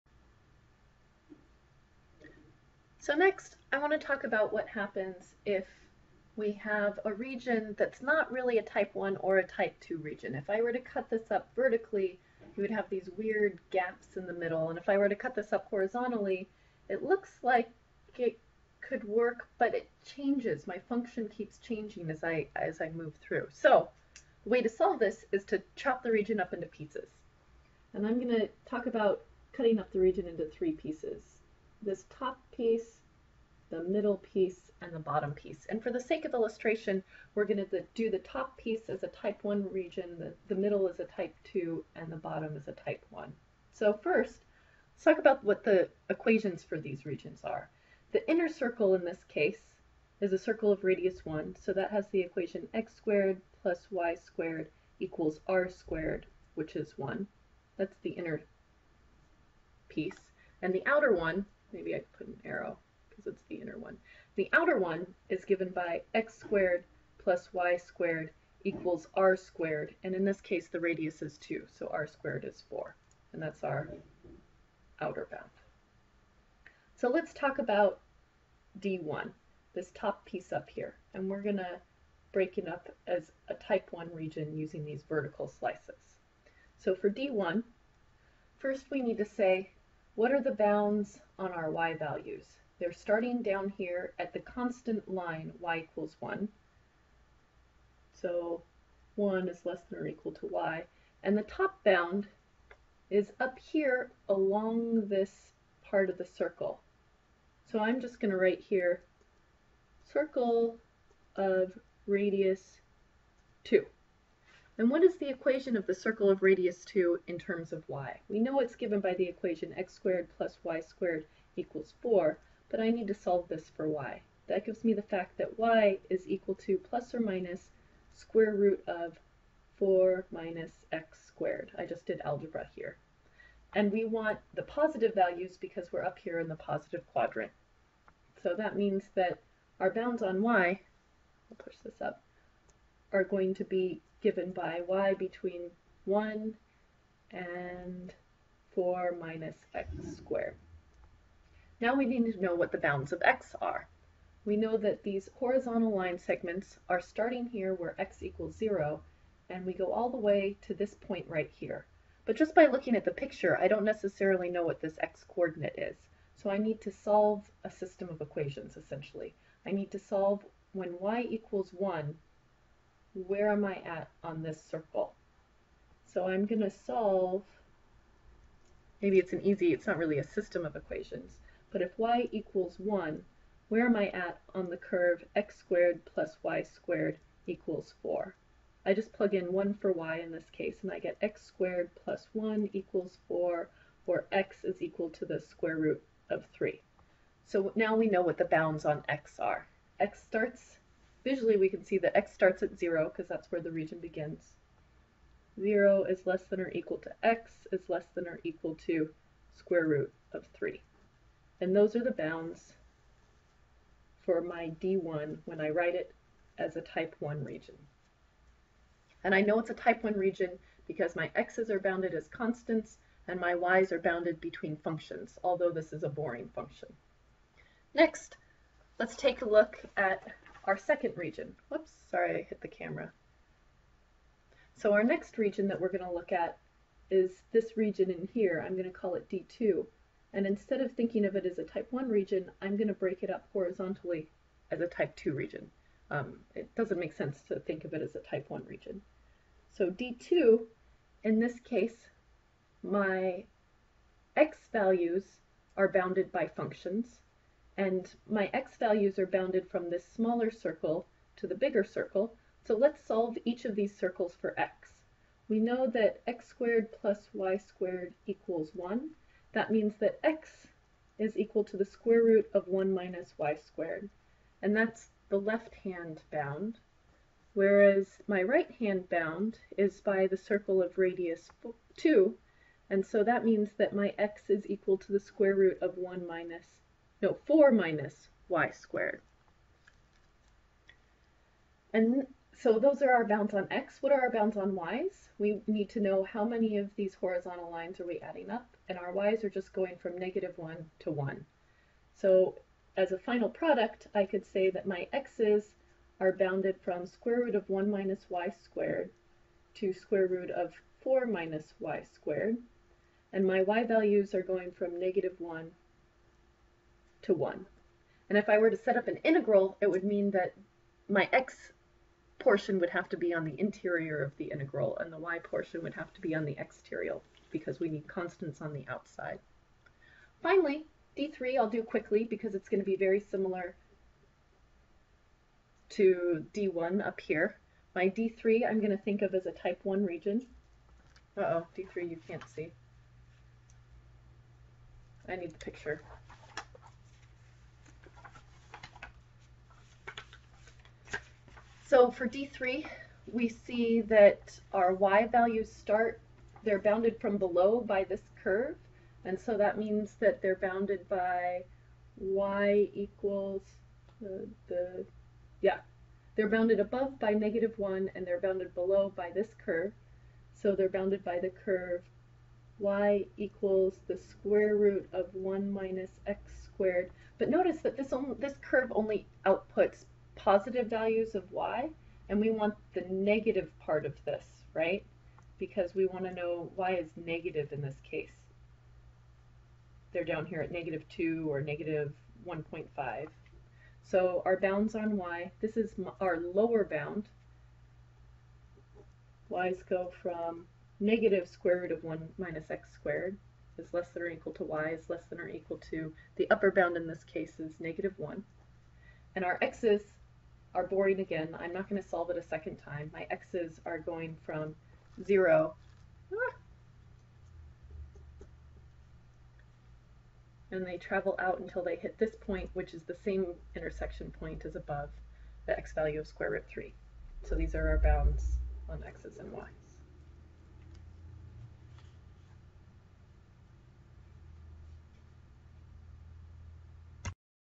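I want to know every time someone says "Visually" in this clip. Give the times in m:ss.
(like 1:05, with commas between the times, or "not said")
3:21.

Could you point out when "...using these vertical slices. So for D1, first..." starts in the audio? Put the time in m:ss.
1:24.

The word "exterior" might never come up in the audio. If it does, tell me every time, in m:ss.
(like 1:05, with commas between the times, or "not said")
5:26.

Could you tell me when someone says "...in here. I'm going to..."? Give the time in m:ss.
3:58.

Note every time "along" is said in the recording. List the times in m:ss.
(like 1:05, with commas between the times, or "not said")
1:44.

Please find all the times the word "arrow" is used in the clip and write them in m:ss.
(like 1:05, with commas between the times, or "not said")
1:02.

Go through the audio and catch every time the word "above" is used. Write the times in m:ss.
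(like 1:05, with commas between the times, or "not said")
6:06, 7:04.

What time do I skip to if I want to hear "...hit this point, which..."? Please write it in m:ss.
7:01.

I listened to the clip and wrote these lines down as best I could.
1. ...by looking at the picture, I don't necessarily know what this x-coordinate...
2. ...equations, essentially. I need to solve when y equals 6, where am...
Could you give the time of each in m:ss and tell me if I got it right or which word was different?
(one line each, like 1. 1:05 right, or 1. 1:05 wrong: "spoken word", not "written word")
1. 2:42 right
2. 2:48 wrong: "1", not "6".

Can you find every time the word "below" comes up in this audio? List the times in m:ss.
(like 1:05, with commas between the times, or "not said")
5:57, 6:08.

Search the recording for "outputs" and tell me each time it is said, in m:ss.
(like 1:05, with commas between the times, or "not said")
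6:19.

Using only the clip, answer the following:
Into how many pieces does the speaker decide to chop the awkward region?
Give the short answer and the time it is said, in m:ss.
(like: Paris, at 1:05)
3, at 0:30.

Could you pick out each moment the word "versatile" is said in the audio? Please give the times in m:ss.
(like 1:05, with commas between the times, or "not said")
not said.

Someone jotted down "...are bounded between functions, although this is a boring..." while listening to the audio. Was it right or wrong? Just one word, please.
right.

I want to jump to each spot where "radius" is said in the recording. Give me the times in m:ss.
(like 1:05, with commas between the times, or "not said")
0:50, 1:10, 1:52, 1:56, 4:40.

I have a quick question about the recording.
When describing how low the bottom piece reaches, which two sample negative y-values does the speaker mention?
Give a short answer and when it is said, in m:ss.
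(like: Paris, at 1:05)
-2 or -1.5, at 6:30.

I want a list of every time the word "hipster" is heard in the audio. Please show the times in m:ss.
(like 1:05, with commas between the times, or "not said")
not said.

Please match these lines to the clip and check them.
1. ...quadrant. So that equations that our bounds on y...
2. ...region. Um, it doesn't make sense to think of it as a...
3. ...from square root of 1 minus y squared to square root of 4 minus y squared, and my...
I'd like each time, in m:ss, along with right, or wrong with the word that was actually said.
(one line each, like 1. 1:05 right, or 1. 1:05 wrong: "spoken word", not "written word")
1. 2:17 wrong: "means", not "equations"
2. 4:05 right
3. 5:06 right.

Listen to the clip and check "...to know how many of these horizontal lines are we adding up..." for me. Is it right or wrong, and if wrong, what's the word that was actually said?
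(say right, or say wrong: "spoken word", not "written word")
right.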